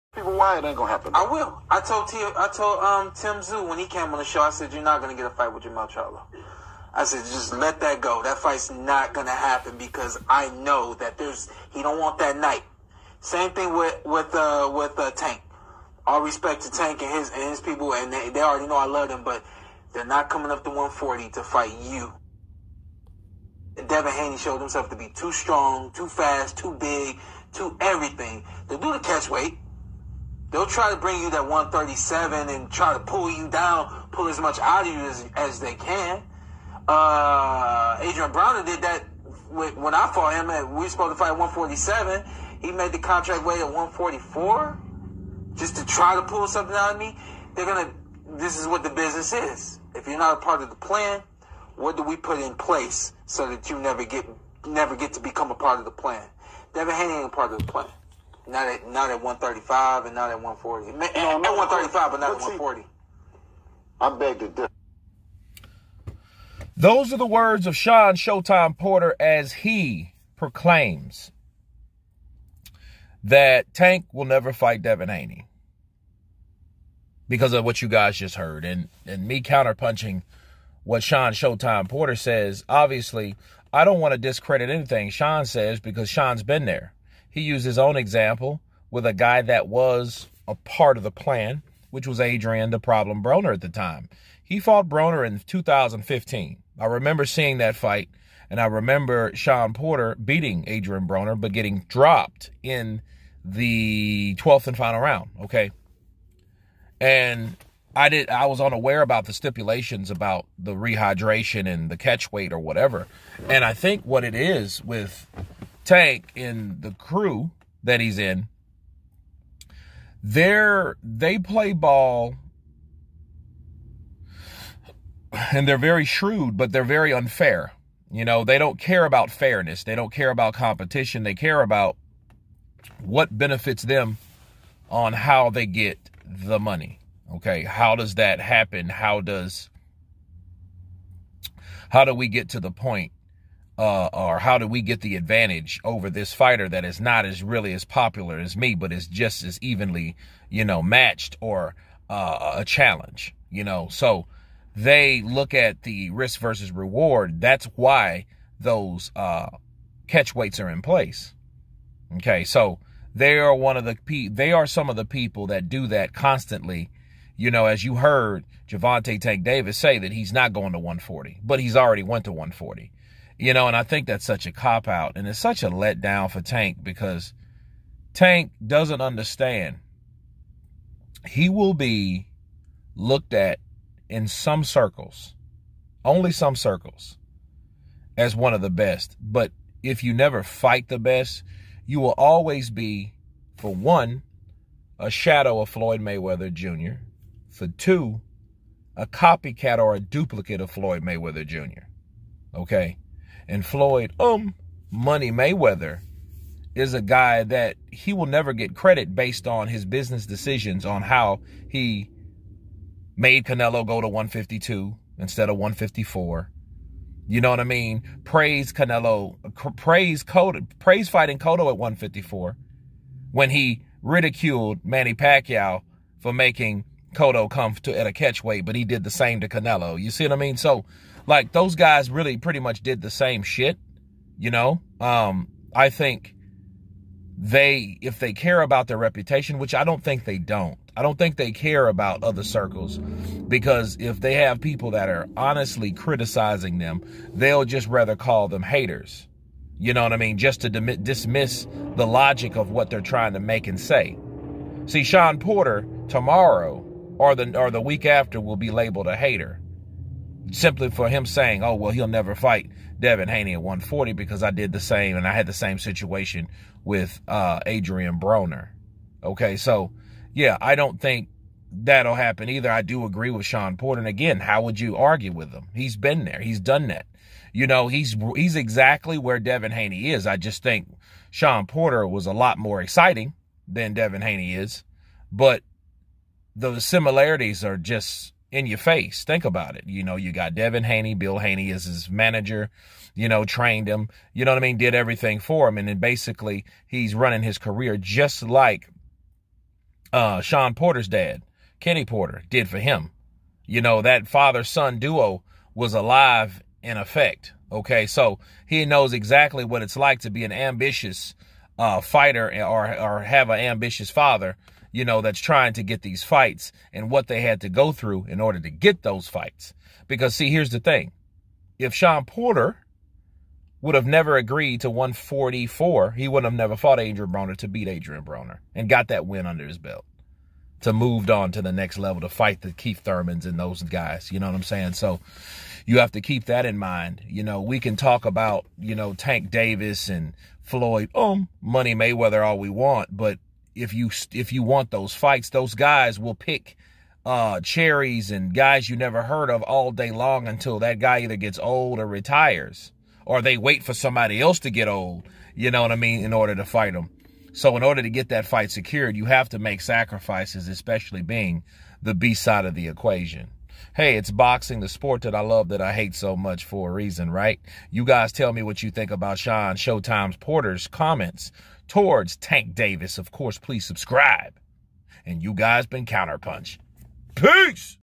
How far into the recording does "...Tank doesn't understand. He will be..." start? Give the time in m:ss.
2:58.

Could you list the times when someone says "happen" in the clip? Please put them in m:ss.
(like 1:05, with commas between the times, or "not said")
0:00, 0:09, 2:18, 4:32.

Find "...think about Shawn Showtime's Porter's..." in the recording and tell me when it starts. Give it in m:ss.
6:08.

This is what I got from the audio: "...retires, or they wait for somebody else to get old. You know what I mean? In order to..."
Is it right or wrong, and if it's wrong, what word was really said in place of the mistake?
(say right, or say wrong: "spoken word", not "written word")
right.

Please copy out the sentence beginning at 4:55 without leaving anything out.
And then basically he's running his career just like uh, Shawn Porter's dad, Kenny Porter, did for him.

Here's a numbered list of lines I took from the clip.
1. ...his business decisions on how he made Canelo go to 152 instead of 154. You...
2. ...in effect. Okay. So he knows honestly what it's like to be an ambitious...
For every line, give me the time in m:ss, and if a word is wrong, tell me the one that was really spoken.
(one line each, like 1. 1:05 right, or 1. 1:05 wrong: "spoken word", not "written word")
1. 3:29 right
2. 5:06 wrong: "exactly", not "honestly".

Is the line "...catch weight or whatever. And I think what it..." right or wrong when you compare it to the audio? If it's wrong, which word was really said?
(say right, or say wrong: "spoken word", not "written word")
right.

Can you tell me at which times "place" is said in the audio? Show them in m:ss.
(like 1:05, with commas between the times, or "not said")
0:52, 2:40.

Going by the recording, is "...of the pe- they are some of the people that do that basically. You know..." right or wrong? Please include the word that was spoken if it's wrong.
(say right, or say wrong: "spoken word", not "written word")
wrong: "constantly", not "basically".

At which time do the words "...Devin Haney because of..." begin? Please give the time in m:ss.
1:14.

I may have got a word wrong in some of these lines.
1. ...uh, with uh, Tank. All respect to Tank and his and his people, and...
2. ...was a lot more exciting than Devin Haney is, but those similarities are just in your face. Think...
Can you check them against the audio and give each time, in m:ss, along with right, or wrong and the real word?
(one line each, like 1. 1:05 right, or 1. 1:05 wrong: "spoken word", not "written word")
1. 0:14 right
2. 4:42 right.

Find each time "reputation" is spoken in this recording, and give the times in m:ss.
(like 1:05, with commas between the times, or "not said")
3:58.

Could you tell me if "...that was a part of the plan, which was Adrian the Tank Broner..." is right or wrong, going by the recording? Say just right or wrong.
wrong.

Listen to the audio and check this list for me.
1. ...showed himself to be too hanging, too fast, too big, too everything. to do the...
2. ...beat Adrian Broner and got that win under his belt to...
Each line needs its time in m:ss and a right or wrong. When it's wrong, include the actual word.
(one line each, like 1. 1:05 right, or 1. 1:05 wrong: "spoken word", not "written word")
1. 0:24 wrong: "strong", not "hanging"
2. 5:27 right.